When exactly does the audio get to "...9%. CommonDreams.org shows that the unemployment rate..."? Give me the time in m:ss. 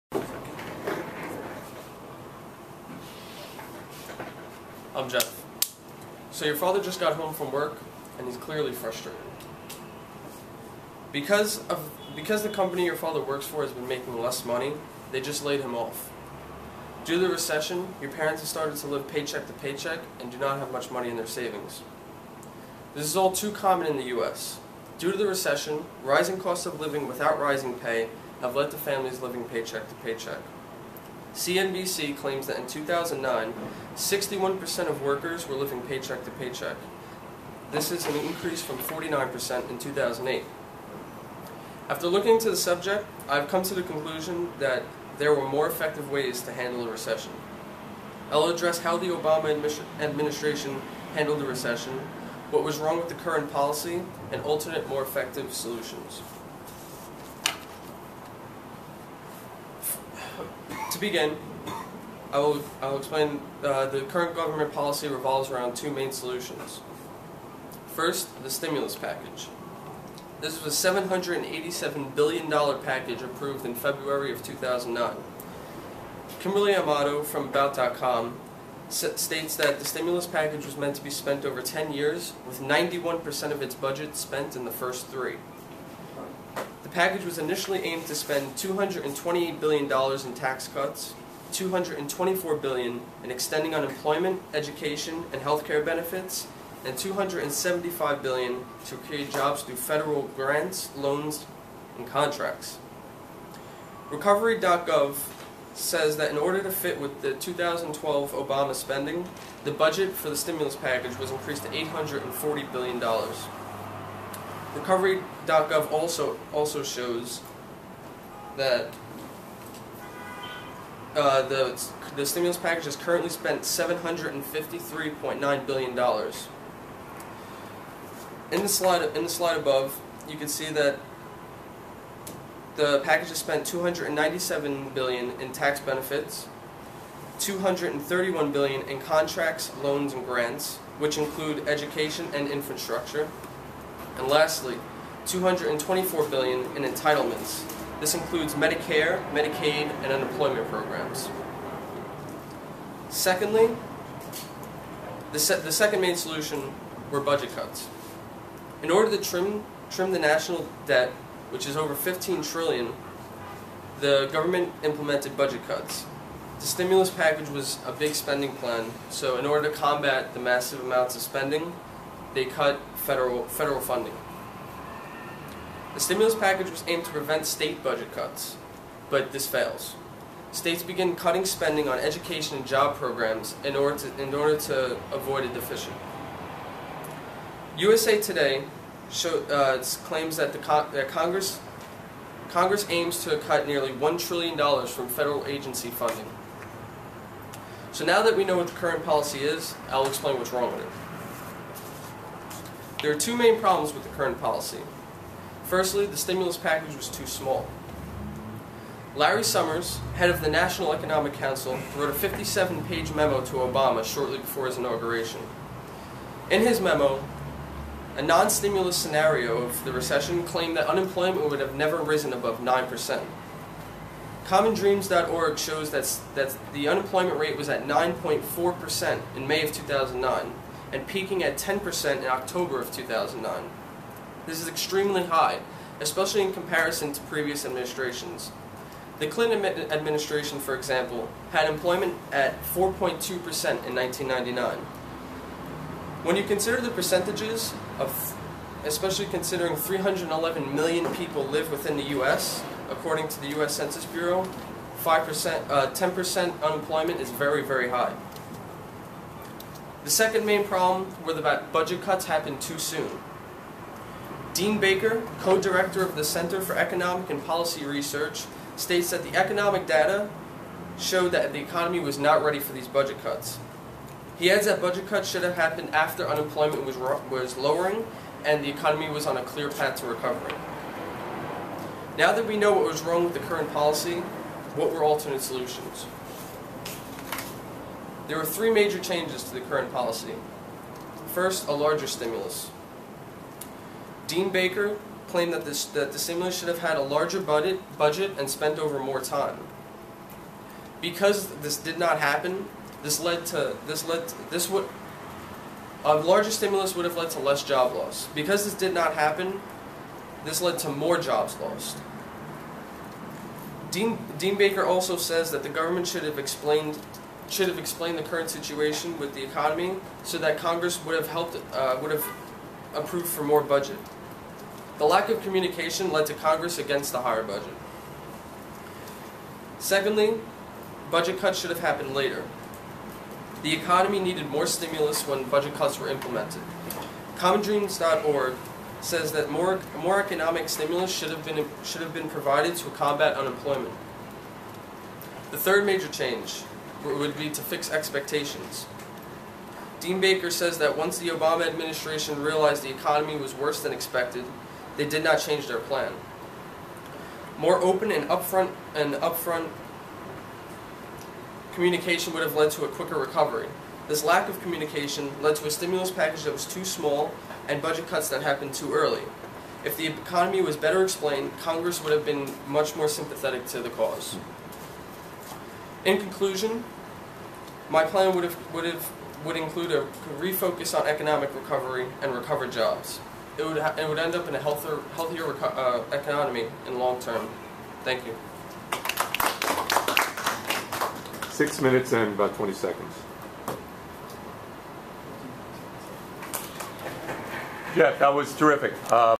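3:42.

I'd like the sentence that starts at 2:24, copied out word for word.
And lastly, 224 billion in entitlements.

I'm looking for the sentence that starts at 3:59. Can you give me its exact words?
The Clinton administration, for example, had employment at 4.2% in 1999.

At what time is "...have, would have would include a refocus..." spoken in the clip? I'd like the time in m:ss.
6:18.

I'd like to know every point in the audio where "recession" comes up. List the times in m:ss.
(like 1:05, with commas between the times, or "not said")
0:17, 0:25, 0:46, 0:51, 3:39.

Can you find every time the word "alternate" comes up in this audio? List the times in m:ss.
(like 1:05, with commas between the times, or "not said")
0:54, 4:45.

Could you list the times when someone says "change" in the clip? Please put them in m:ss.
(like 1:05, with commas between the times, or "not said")
4:48, 5:46, 5:55.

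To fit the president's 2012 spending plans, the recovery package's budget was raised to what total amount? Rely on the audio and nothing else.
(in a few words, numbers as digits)
$840 billion.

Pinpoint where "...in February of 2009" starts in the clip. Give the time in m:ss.
1:13.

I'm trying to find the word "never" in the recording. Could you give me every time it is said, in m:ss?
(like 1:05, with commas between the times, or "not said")
3:41.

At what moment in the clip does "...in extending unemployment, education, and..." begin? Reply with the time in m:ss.
1:33.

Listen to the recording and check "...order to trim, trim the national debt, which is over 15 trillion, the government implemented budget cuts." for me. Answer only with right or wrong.
right.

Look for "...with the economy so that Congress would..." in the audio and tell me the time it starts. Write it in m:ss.
5:19.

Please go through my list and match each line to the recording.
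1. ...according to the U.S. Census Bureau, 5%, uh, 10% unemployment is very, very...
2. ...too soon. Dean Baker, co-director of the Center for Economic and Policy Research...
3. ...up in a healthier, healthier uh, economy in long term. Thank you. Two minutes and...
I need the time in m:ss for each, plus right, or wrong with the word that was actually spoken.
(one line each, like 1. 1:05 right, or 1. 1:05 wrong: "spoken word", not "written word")
1. 4:12 right
2. 4:22 right
3. 6:24 wrong: "Six", not "Two".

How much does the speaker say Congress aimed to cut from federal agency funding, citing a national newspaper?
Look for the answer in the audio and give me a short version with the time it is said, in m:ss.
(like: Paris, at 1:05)
nearly $1 trillion, at 3:13.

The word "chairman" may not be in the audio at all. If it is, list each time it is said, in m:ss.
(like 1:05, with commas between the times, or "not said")
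not said.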